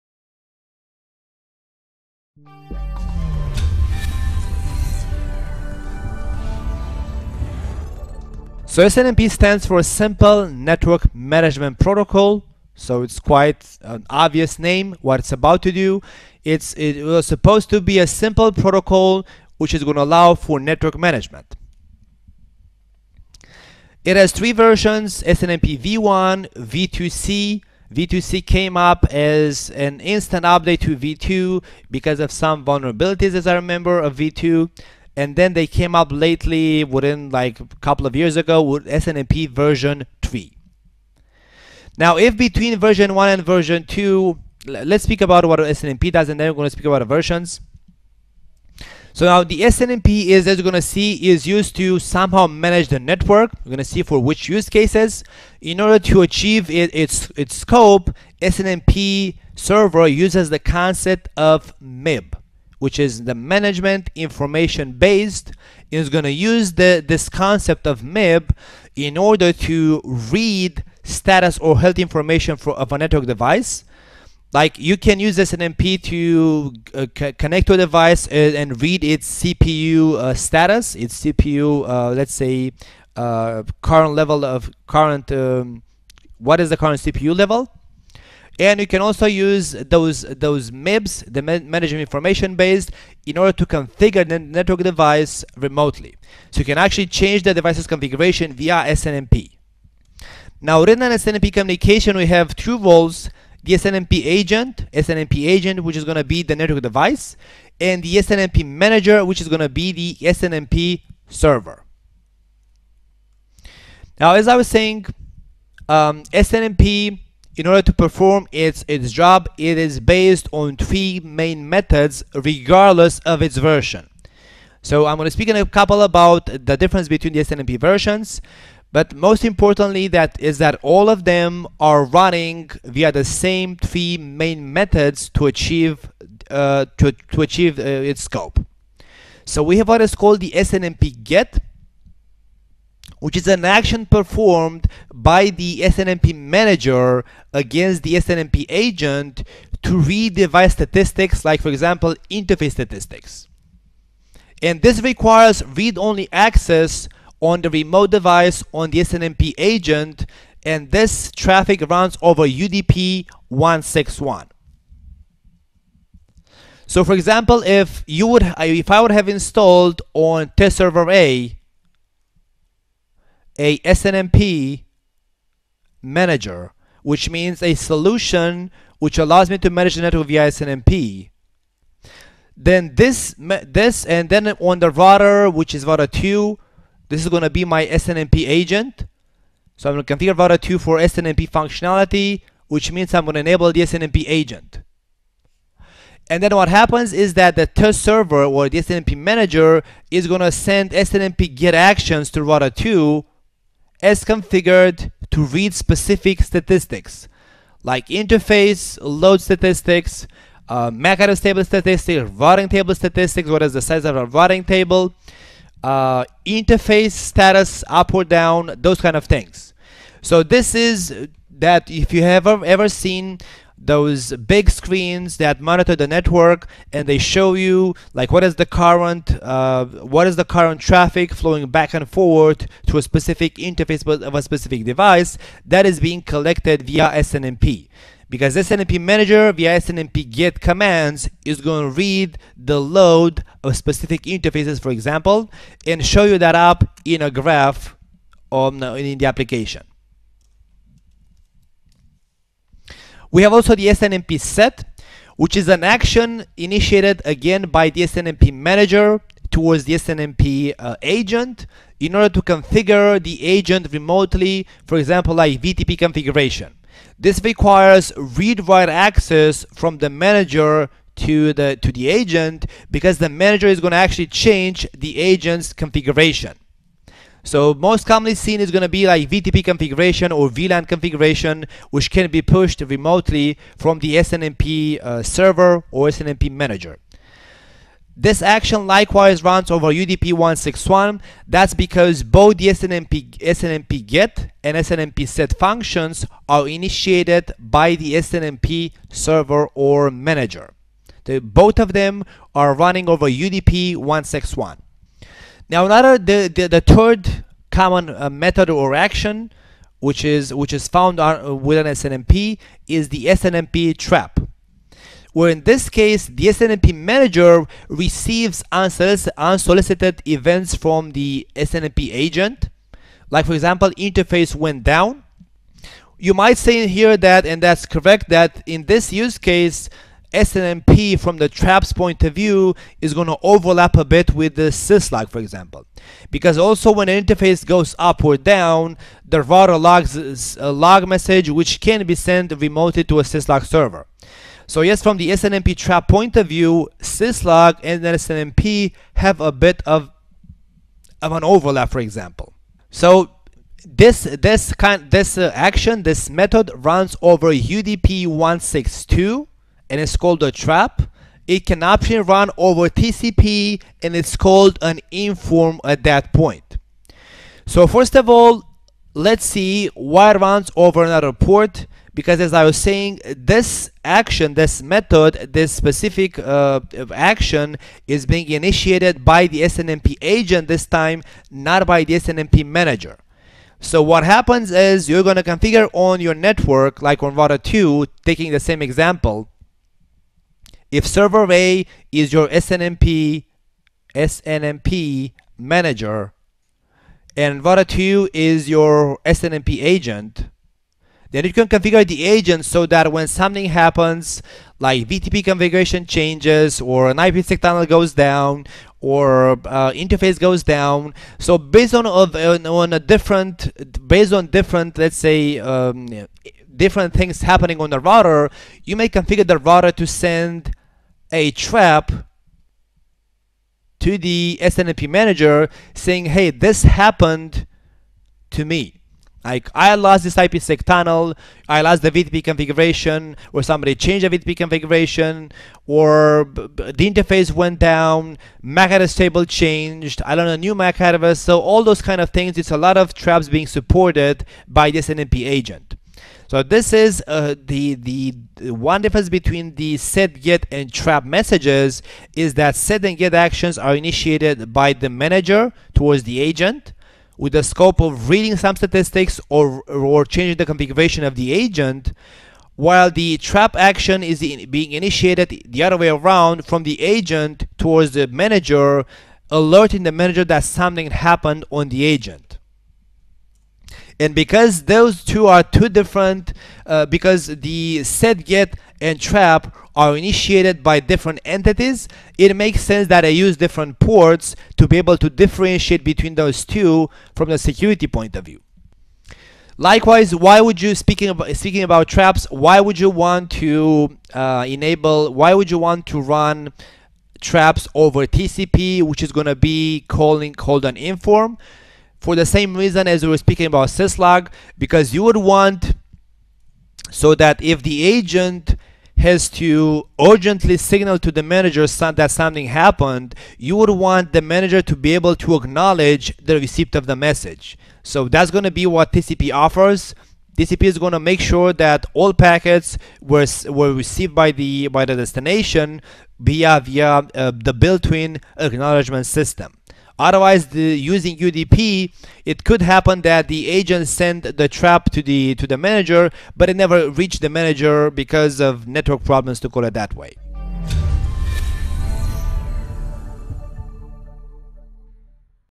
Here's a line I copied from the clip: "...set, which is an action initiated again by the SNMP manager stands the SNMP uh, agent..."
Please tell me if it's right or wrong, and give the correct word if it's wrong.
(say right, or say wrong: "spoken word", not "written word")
wrong: "towards", not "stands".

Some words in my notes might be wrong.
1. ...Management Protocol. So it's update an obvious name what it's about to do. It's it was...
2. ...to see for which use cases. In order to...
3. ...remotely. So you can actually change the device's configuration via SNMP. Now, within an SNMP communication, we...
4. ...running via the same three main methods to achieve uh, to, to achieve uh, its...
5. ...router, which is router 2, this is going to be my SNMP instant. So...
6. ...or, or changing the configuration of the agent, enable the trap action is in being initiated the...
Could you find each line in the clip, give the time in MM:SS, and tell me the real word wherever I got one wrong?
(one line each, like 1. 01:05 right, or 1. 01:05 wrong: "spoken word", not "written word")
1. 00:11 wrong: "quite", not "update"
2. 00:53 right
3. 01:35 right
4. 02:12 right
5. 03:04 wrong: "agent", not "instant"
6. 07:39 wrong: "while", not "enable".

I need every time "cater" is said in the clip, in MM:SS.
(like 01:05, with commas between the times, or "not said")
not said.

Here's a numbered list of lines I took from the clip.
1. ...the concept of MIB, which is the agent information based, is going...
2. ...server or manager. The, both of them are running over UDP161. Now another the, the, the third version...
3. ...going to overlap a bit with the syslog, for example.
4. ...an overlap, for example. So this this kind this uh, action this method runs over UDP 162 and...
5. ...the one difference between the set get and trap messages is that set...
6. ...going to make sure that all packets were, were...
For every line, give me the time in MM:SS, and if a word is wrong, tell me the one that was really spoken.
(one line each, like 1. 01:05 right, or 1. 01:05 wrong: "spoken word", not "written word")
1. 01:00 wrong: "management", not "agent"
2. 04:59 wrong: "common", not "version"
3. 05:33 right
4. 05:51 right
5. 07:28 right
6. 08:40 right.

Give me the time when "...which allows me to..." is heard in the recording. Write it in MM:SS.
02:58.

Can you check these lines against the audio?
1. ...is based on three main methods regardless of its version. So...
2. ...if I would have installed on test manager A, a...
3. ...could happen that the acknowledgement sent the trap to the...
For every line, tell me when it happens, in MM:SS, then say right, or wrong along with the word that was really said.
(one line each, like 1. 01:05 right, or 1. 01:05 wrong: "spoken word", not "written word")
1. 01:59 right
2. 02:48 wrong: "server", not "manager"
3. 08:52 wrong: "agent", not "acknowledgement".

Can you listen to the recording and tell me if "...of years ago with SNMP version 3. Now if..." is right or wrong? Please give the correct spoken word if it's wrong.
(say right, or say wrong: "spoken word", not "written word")
right.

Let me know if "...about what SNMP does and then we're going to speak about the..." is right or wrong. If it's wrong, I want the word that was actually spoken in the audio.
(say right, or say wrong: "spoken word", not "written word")
right.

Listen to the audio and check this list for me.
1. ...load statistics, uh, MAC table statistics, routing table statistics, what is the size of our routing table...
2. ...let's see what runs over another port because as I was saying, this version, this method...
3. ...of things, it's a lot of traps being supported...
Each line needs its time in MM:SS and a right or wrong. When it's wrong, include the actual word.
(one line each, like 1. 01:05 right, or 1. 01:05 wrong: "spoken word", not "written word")
1. 03:29 right
2. 06:09 wrong: "action", not "version"
3. 07:22 right.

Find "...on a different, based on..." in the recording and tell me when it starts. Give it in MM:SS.
06:52.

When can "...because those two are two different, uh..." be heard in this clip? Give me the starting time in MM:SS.
07:54.